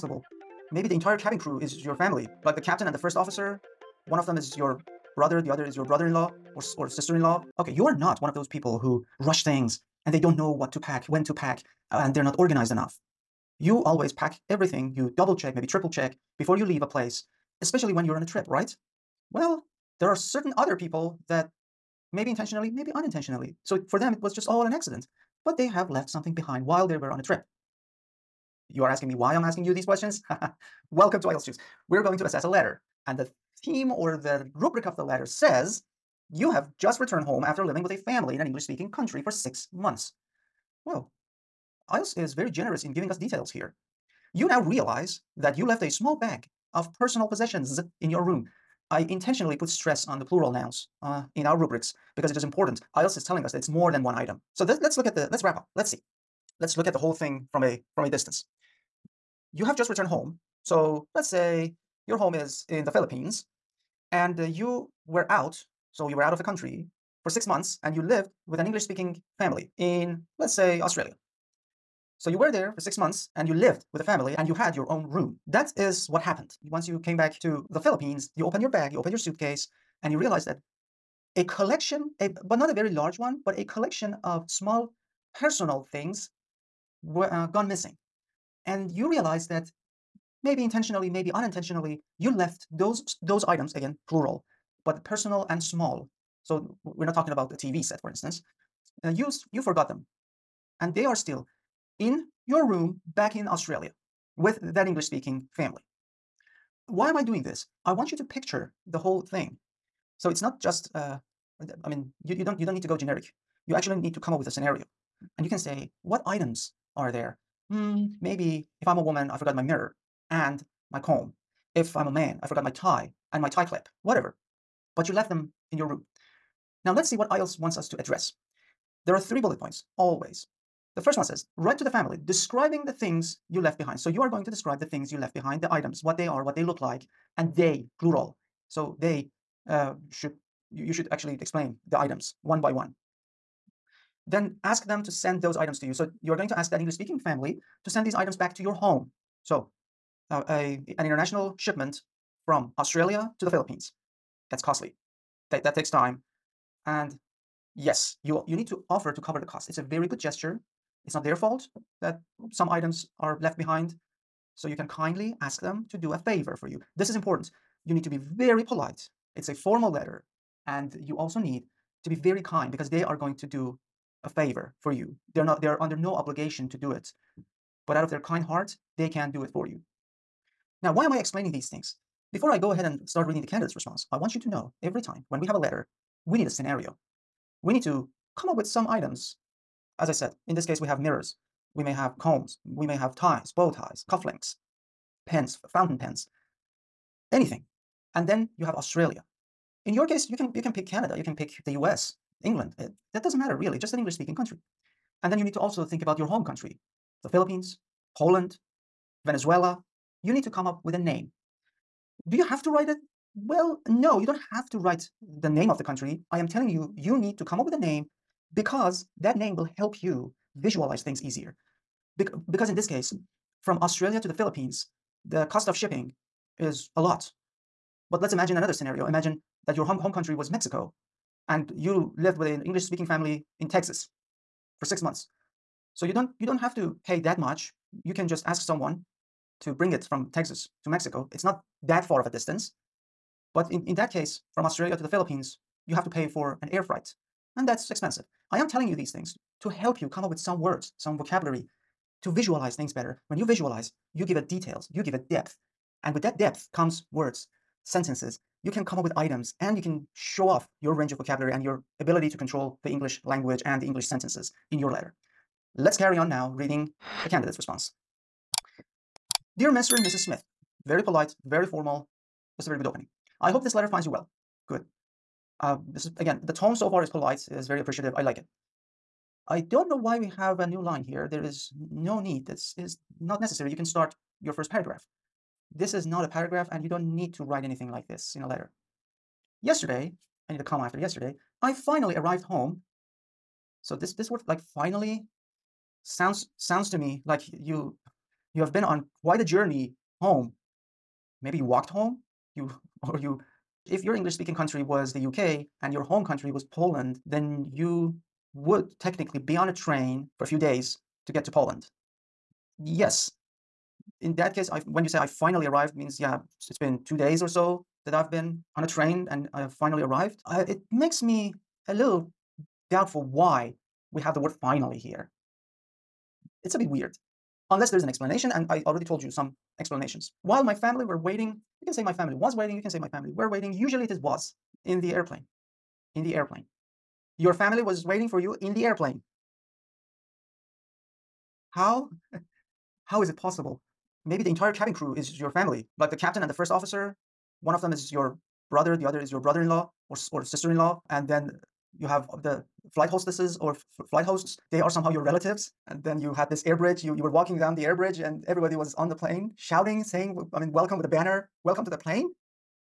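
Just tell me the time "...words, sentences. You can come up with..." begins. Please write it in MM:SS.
04:17.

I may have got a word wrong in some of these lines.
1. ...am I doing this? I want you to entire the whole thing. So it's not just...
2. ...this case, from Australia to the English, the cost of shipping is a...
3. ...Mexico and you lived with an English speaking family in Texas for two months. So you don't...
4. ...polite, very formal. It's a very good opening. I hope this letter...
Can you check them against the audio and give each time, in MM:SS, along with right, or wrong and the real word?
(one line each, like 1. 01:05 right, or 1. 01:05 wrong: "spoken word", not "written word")
1. 01:47 wrong: "picture", not "entire"
2. 03:42 wrong: "Philippines", not "English"
3. 03:50 wrong: "six", not "two"
4. 04:31 right.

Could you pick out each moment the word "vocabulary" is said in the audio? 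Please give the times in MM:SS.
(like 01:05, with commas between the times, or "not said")
04:11, 04:21.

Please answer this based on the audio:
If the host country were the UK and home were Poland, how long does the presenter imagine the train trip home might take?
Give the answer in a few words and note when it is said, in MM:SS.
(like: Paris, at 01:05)
2 days, at 05:17.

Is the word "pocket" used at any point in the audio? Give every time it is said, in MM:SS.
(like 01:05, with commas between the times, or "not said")
not said.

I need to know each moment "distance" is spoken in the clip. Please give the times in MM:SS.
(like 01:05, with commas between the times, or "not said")
00:58, 04:02.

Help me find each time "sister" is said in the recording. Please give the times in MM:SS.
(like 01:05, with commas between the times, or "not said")
00:06, 05:50.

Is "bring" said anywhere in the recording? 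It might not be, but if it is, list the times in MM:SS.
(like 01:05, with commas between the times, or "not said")
03:59.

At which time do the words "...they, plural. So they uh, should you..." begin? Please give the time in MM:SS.
02:17.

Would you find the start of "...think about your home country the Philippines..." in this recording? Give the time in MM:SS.
03:25.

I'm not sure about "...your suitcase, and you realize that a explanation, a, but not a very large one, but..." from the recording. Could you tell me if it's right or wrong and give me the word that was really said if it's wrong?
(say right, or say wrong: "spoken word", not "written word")
wrong: "collection", not "explanation".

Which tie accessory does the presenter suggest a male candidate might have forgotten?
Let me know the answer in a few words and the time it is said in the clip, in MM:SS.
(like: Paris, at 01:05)
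tie clip, at 02:03.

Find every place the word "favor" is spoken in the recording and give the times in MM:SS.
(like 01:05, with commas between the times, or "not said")
02:46, 02:54.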